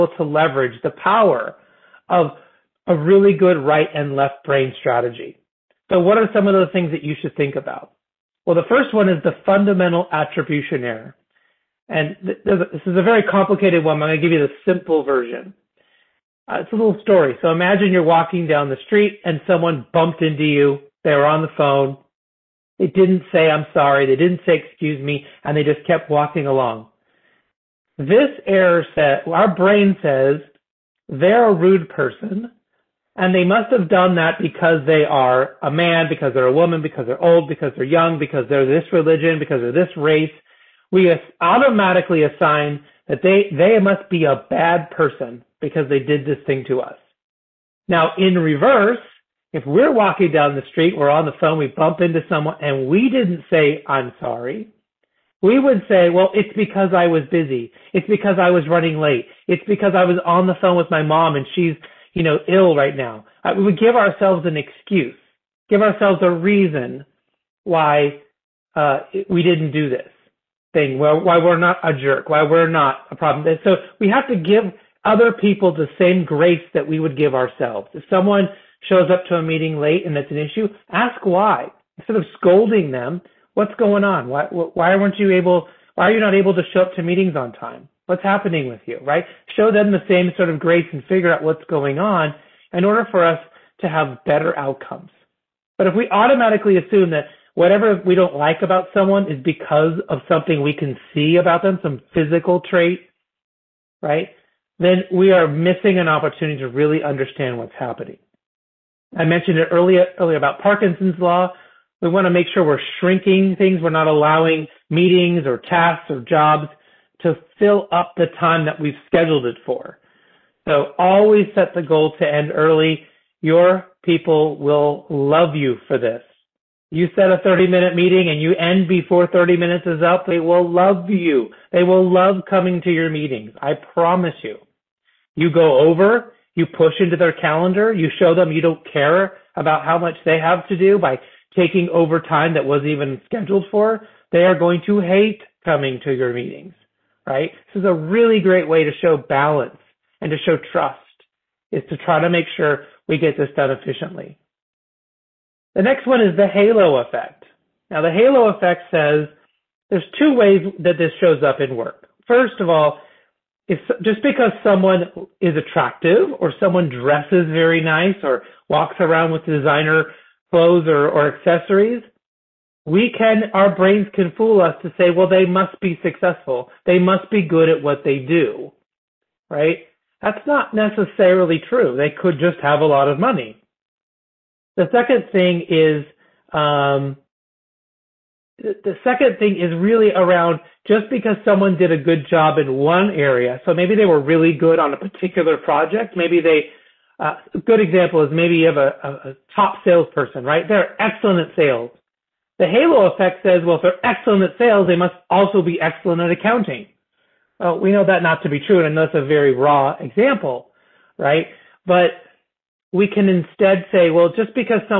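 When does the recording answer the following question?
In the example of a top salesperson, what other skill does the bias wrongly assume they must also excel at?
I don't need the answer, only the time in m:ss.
3:26.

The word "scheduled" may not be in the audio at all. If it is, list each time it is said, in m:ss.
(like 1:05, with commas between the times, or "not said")
1:59, 2:23.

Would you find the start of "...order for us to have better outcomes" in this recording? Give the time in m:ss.
1:32.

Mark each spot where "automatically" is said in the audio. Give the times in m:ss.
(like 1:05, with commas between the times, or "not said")
0:41, 1:36.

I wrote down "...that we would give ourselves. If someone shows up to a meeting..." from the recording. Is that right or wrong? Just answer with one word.
right.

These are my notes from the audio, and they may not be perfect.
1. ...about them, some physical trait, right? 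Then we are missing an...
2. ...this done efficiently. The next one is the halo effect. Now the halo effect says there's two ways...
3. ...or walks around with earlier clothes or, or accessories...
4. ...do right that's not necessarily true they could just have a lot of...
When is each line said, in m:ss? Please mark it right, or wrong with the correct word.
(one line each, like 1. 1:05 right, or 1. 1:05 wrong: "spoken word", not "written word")
1. 1:41 right
2. 2:33 right
3. 2:48 wrong: "designer", not "earlier"
4. 2:58 right.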